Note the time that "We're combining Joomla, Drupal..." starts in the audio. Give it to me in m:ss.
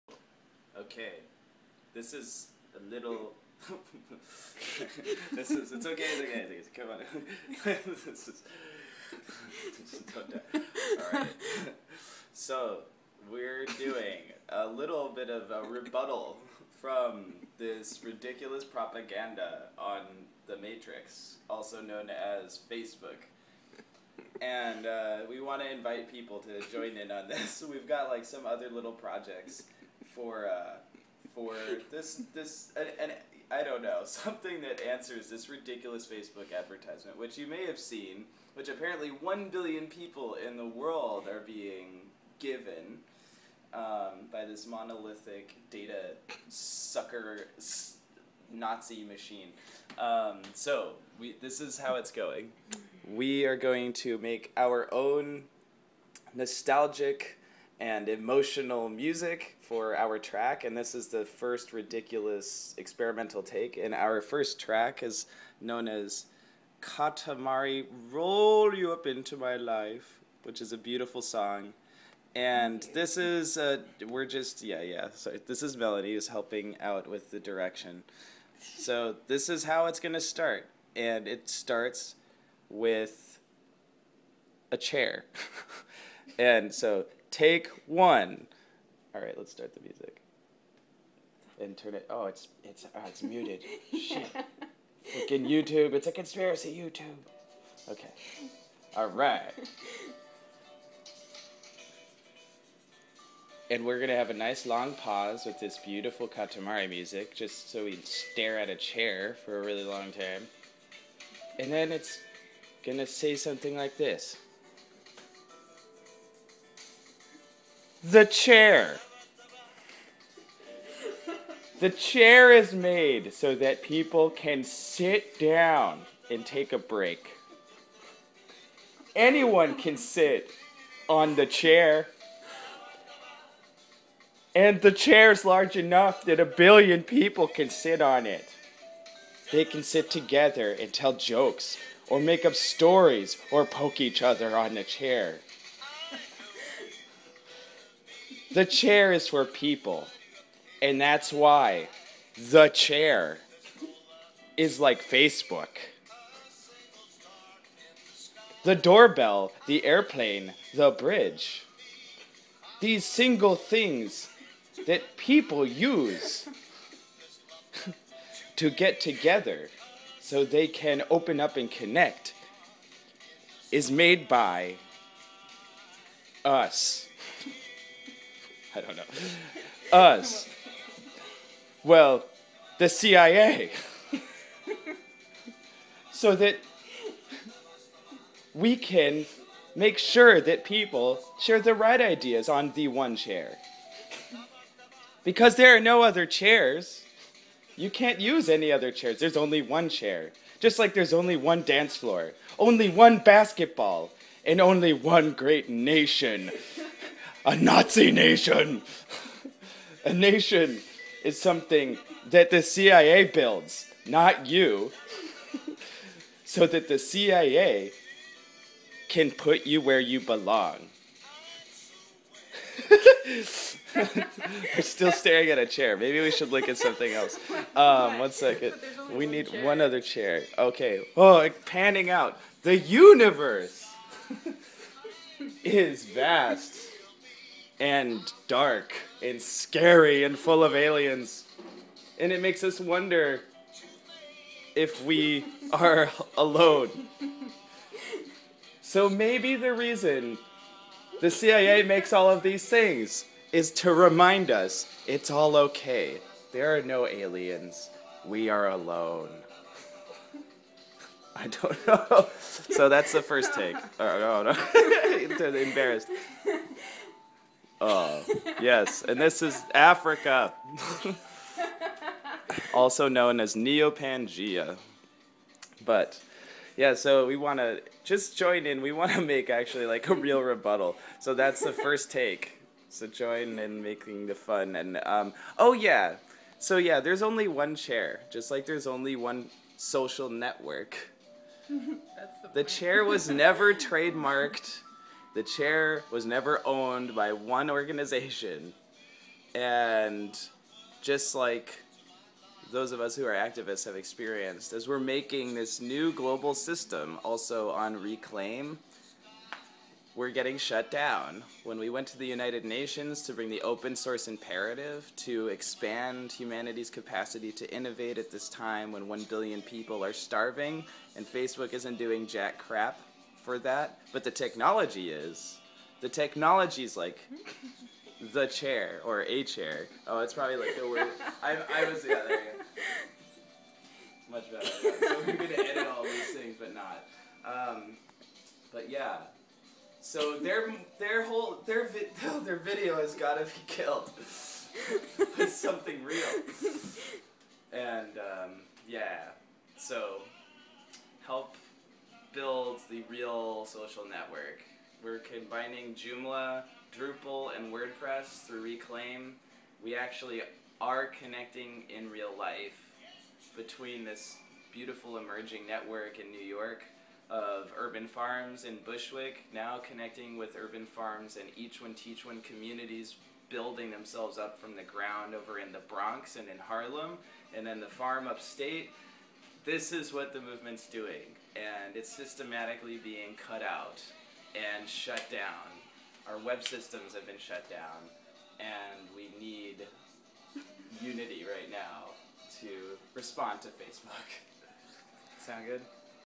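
5:55.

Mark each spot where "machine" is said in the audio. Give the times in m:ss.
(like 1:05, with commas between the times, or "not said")
0:49.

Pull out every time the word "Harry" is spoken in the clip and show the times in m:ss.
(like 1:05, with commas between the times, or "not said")
not said.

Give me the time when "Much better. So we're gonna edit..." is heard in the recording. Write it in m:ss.
5:34.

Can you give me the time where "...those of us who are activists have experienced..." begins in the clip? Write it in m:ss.
5:02.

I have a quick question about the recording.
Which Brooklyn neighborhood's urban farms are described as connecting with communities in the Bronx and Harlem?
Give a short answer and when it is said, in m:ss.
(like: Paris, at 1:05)
Bushwick, at 6:08.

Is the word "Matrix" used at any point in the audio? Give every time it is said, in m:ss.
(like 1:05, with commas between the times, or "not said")
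0:20.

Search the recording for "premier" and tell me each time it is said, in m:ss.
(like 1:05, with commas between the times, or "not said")
not said.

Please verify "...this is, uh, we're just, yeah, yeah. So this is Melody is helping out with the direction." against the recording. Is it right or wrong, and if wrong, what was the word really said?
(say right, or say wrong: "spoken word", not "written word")
right.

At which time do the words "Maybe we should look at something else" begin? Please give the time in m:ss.
3:45.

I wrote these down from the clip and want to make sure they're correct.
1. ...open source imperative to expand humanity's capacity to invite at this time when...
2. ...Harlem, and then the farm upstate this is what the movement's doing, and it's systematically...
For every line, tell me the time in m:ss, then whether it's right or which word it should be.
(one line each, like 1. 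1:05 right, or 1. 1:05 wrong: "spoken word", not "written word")
1. 5:13 wrong: "innovate", not "invite"
2. 6:16 right.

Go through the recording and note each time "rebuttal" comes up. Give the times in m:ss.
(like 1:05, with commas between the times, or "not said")
0:15, 4:40.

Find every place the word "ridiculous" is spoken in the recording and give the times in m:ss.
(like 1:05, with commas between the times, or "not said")
0:18, 0:35, 1:01.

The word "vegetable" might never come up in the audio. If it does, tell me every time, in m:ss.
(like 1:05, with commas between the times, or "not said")
not said.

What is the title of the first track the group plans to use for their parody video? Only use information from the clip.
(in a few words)
Katamari Roll You Up Into My Life.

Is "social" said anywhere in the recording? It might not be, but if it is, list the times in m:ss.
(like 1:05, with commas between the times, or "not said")
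4:49, 5:53.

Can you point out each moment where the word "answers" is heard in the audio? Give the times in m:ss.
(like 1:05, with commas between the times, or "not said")
0:34.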